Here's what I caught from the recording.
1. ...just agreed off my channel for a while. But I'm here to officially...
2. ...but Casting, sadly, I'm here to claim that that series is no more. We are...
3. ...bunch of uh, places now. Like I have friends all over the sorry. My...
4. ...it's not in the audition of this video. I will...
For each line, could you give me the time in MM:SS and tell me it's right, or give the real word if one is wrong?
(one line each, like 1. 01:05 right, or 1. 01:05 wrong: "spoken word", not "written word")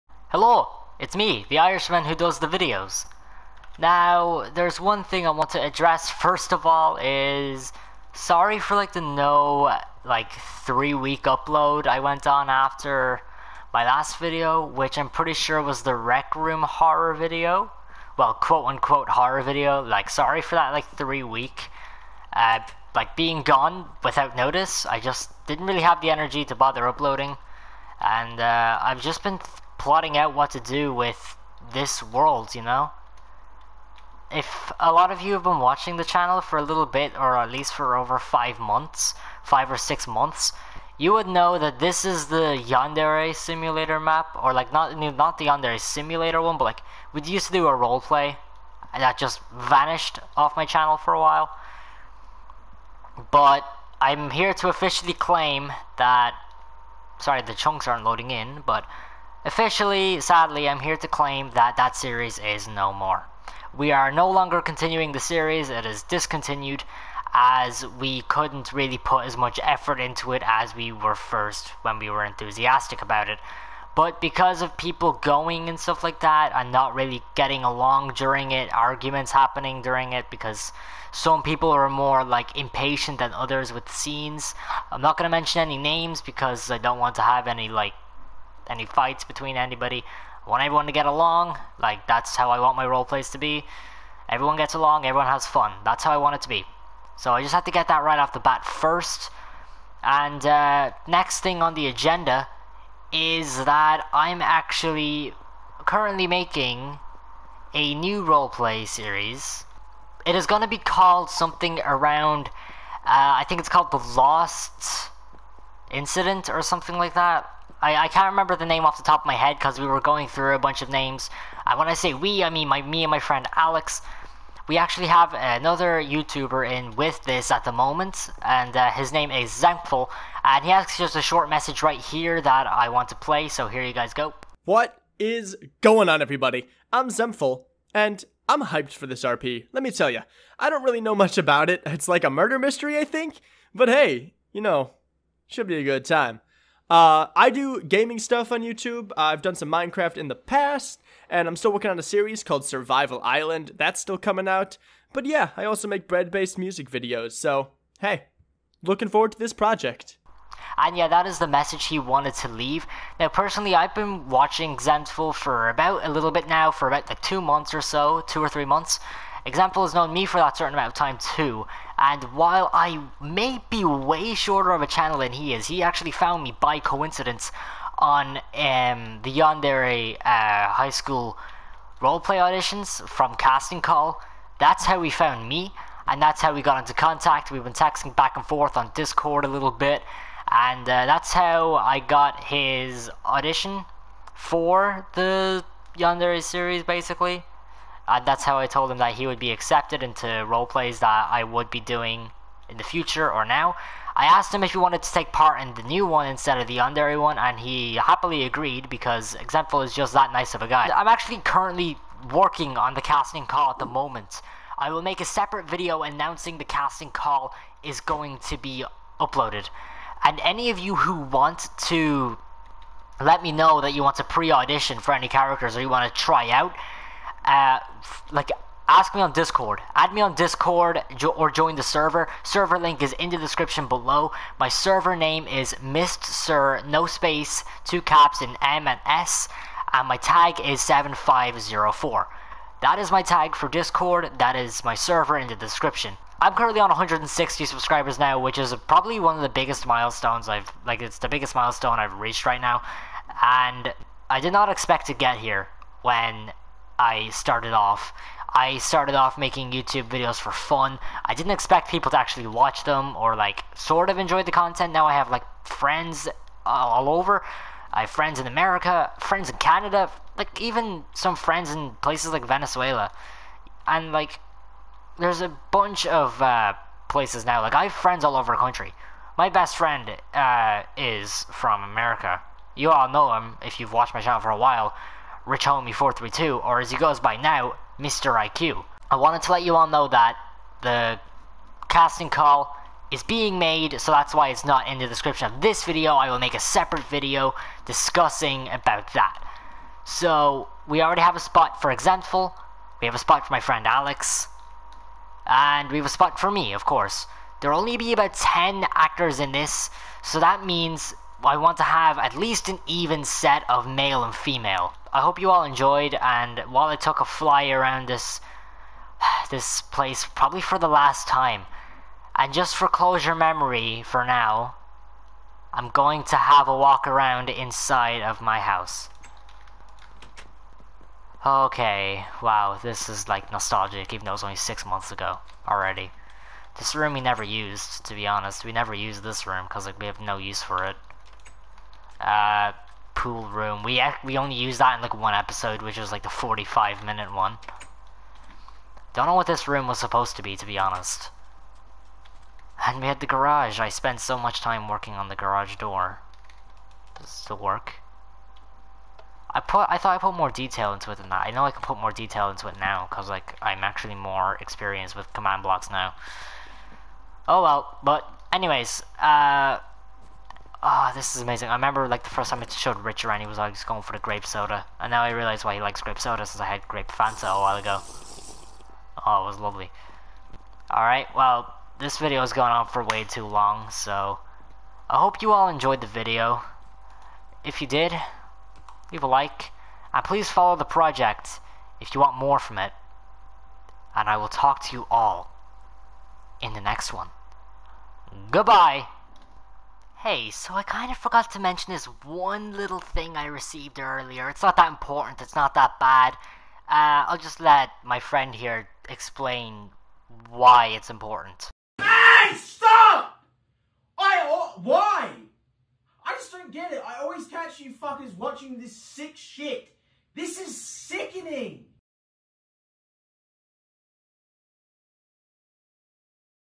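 1. 00:49 wrong: "vanished", not "agreed"
2. 00:58 wrong: "Officially", not "Casting"
3. 04:35 wrong: "country", not "sorry"
4. 04:54 wrong: "description", not "audition".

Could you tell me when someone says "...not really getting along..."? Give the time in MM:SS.
01:16.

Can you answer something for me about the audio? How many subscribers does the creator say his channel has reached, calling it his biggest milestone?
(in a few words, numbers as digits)
160.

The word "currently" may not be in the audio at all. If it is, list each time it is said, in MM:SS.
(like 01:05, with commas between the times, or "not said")
01:45, 03:31, 04:06.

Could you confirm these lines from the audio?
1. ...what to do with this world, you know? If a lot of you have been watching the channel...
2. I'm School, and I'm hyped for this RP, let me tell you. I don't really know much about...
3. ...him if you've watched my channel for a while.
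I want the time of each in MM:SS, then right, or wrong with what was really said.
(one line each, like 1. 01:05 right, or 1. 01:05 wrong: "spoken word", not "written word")
1. 00:30 right
2. 02:16 wrong: "Xemptful", not "School"
3. 04:43 right.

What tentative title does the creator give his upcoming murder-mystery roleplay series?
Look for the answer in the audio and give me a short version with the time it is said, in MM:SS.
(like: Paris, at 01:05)
The Lost Incident, at 01:53.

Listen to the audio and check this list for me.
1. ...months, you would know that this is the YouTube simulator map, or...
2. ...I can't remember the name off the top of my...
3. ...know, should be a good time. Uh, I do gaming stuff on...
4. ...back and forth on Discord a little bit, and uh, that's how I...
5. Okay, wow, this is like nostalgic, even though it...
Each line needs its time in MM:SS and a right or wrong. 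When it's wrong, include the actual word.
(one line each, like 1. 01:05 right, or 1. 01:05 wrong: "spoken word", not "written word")
1. 00:40 wrong: "Yandere", not "YouTube"
2. 01:58 right
3. 02:24 right
4. 03:08 right
5. 05:31 right.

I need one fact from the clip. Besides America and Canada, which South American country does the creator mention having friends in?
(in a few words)
Venezuela.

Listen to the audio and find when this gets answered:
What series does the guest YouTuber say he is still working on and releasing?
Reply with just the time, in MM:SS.
02:32.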